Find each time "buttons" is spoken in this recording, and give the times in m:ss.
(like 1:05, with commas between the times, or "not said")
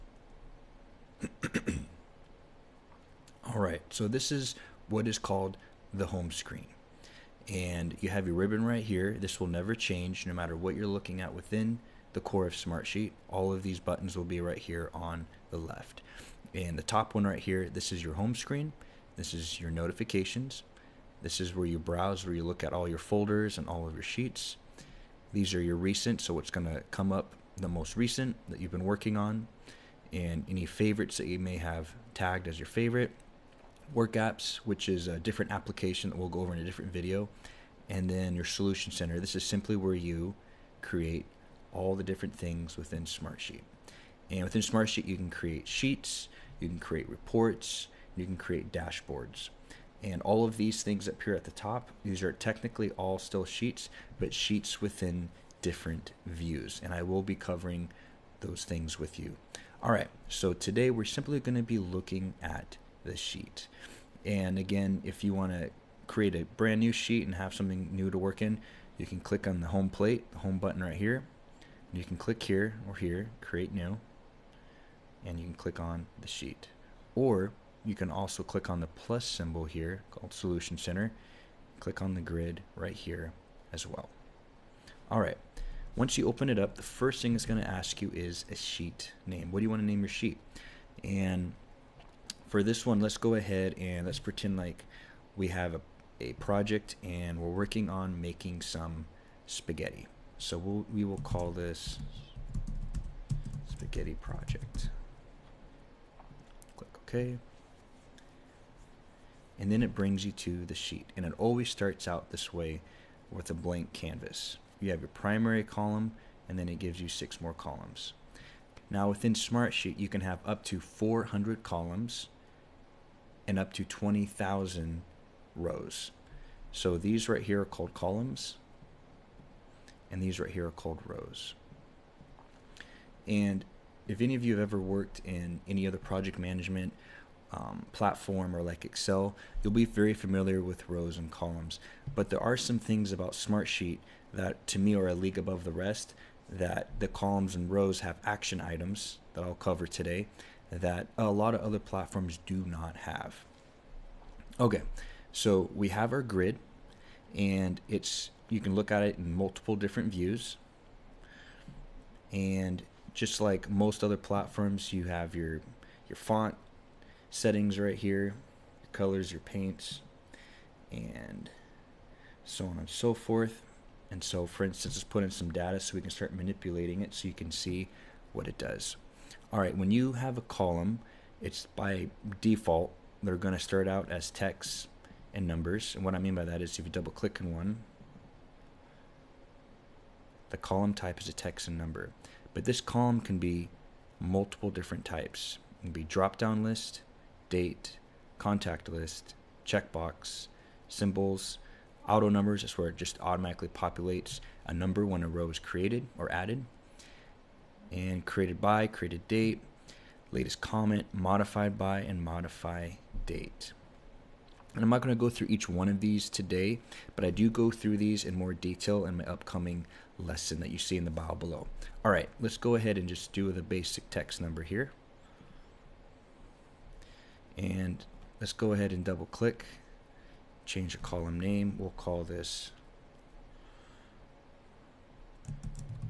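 0:13, 1:10.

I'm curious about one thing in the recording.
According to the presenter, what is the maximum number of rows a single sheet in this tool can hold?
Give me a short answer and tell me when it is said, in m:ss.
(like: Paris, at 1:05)
20,000, at 2:03.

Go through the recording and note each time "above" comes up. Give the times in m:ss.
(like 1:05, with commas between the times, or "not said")
2:25.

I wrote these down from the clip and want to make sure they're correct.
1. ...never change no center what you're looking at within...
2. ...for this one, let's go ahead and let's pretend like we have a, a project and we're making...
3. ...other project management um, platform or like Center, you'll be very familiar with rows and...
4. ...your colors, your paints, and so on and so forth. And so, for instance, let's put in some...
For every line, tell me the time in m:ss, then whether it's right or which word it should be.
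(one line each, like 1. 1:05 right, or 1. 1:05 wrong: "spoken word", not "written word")
1. 0:09 wrong: "matter", not "center"
2. 1:32 wrong: "working", not "making"
3. 2:15 wrong: "Excel", not "Center"
4. 2:48 right.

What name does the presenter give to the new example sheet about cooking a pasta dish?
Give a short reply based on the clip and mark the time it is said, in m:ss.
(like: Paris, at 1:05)
spaghetti project, at 1:43.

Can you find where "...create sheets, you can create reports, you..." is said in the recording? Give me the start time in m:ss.
0:45.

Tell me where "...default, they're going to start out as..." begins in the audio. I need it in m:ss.
3:02.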